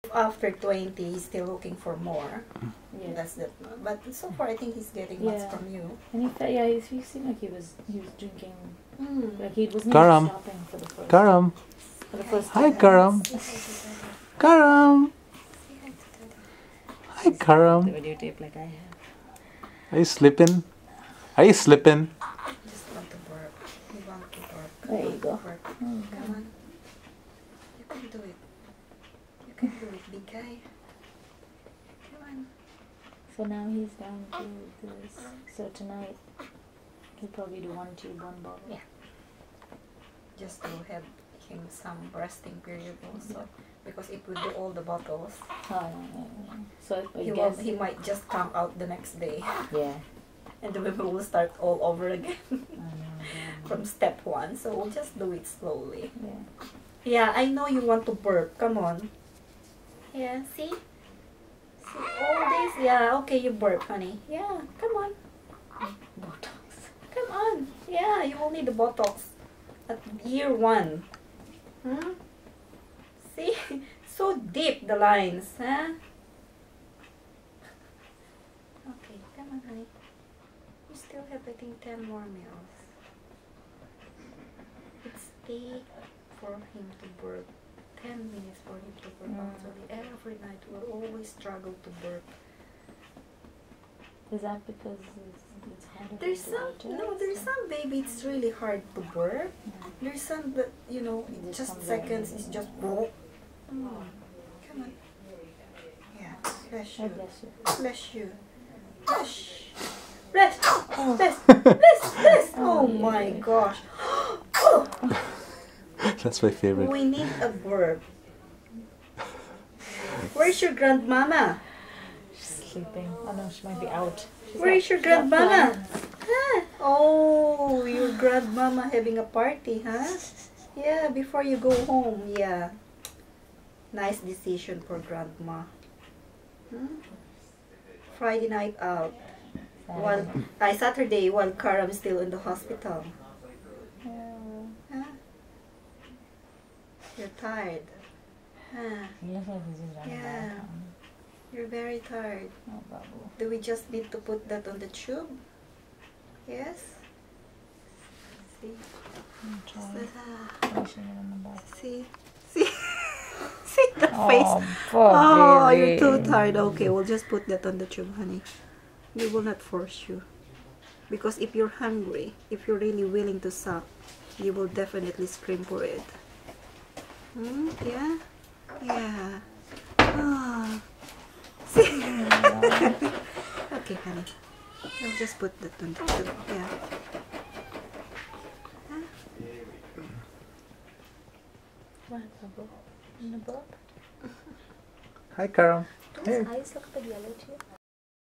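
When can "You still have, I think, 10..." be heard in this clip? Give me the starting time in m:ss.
1:19.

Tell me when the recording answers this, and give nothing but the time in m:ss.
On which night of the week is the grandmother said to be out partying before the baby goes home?
2:18.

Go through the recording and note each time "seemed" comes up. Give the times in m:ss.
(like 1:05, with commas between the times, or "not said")
0:07.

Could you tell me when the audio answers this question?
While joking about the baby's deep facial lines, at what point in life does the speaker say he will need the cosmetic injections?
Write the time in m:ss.
1:10.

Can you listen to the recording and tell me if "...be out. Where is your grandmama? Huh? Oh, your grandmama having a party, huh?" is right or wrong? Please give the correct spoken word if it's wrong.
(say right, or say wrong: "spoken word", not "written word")
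right.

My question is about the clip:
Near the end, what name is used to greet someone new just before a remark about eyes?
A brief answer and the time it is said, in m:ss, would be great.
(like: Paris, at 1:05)
Carol, at 3:15.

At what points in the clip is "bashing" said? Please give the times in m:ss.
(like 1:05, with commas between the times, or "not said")
not said.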